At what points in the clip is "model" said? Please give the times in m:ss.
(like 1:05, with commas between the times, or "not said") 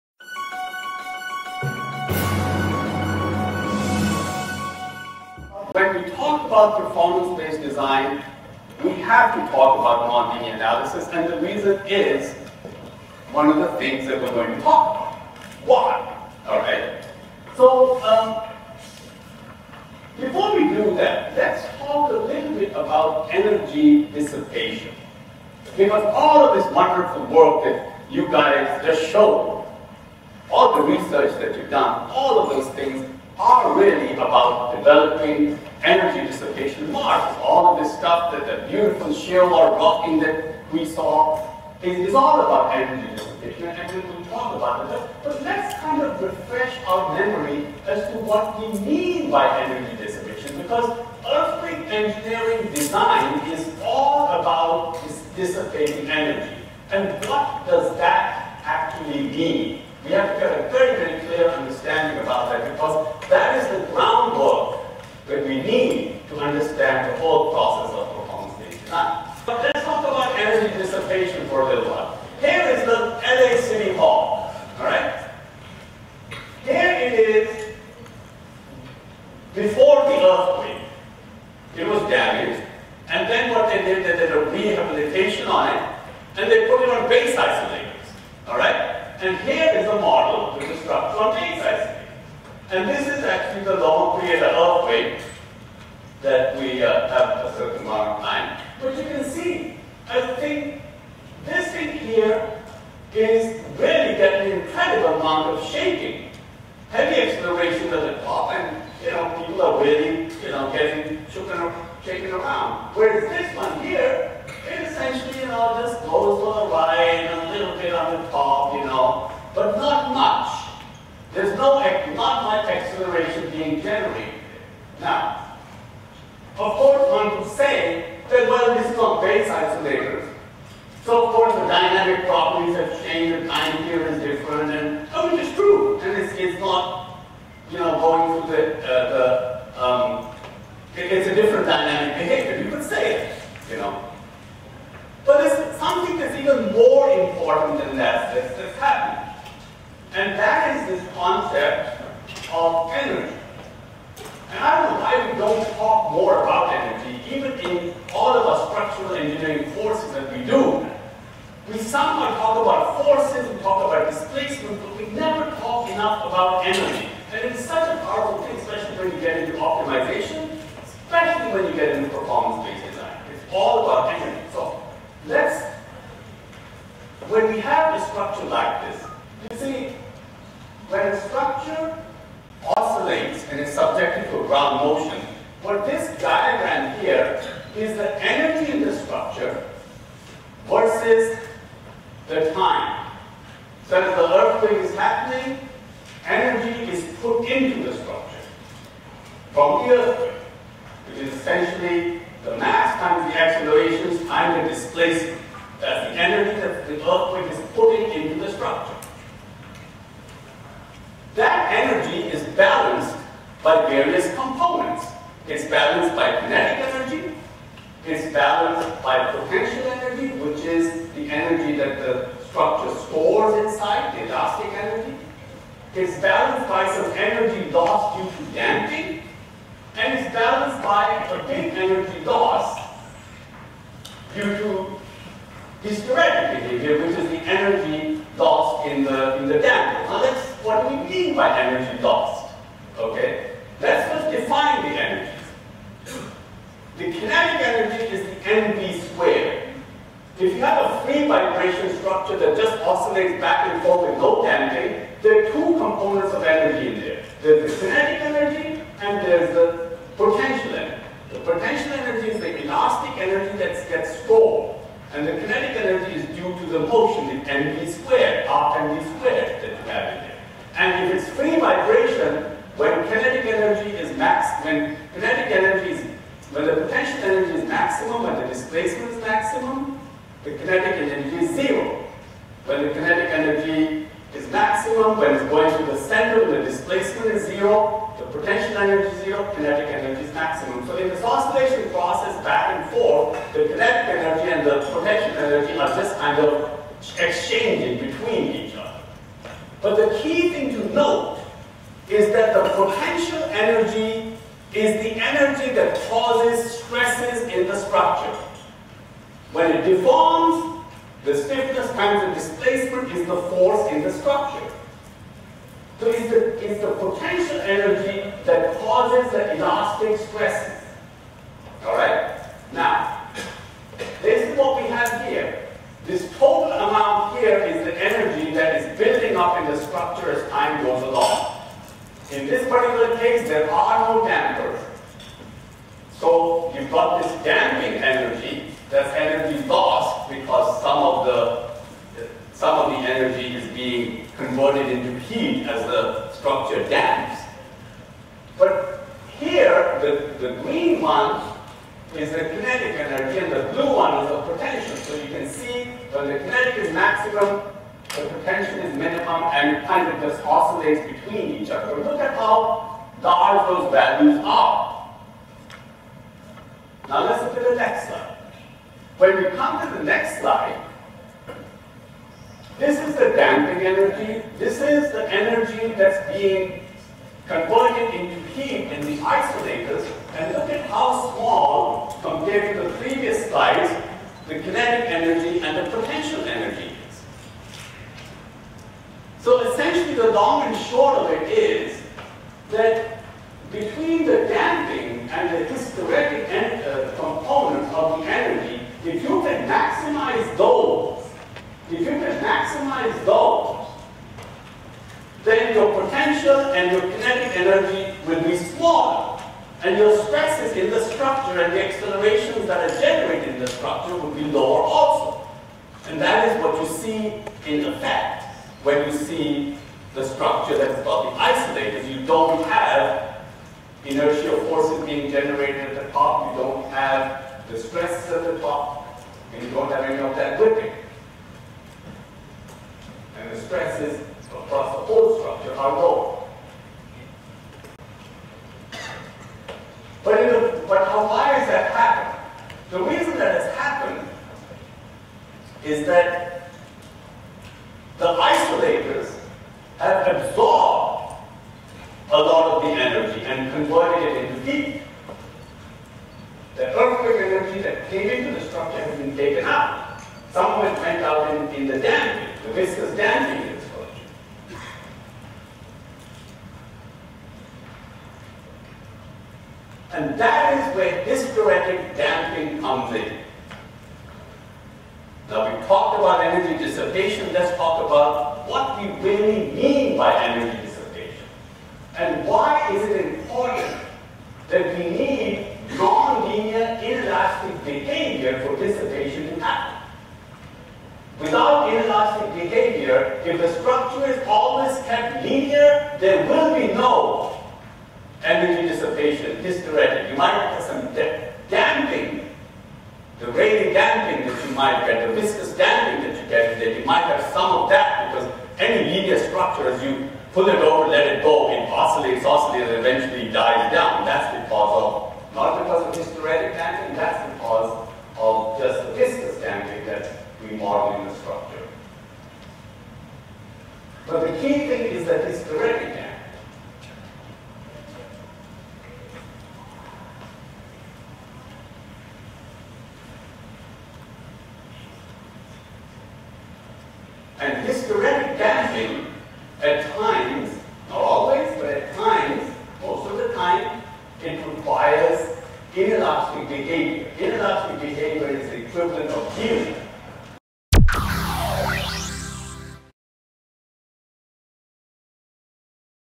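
1:29, 8:40.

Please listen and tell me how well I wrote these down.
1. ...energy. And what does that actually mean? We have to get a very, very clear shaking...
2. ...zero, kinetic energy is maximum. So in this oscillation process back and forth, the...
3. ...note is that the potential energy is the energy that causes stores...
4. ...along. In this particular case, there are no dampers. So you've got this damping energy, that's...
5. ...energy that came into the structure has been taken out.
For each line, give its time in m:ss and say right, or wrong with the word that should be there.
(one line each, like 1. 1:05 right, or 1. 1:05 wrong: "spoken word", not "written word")
1. 0:56 wrong: "understanding", not "shaking"
2. 4:49 right
3. 5:00 wrong: "stresses", not "stores"
4. 5:31 right
5. 7:37 right.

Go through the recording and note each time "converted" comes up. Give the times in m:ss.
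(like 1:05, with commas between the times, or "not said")
5:44, 6:17, 7:33.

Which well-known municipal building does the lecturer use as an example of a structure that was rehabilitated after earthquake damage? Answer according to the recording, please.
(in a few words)
LA City Hall.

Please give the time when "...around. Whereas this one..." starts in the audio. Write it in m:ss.
1:52.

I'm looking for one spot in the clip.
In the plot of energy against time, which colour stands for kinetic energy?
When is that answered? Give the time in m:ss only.
5:50.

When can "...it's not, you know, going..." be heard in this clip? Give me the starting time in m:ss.
2:16.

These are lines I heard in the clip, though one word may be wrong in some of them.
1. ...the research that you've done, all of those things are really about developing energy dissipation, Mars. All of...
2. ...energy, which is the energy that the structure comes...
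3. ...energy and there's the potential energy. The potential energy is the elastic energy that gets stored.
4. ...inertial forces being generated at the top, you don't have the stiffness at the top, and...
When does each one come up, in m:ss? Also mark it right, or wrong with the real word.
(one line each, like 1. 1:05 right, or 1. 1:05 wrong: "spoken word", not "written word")
1. 0:30 right
2. 3:39 wrong: "stores", not "comes"
3. 4:18 right
4. 7:04 wrong: "stress", not "stiffness".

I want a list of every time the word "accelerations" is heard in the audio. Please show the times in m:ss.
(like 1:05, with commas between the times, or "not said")
1:47, 2:02, 3:23, 6:51.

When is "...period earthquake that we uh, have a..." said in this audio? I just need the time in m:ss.
1:34.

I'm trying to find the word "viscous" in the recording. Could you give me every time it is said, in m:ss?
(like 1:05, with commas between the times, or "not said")
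7:42, 8:25, 8:39.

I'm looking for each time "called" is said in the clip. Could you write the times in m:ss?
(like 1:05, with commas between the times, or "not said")
7:43.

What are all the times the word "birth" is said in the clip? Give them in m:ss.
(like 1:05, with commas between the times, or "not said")
not said.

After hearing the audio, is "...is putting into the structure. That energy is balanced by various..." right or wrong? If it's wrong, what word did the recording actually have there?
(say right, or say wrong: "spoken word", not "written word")
right.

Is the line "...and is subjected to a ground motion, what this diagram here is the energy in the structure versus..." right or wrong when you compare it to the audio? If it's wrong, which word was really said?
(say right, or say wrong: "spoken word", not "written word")
right.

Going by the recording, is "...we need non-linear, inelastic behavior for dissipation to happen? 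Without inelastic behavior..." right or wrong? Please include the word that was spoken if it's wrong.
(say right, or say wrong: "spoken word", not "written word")
right.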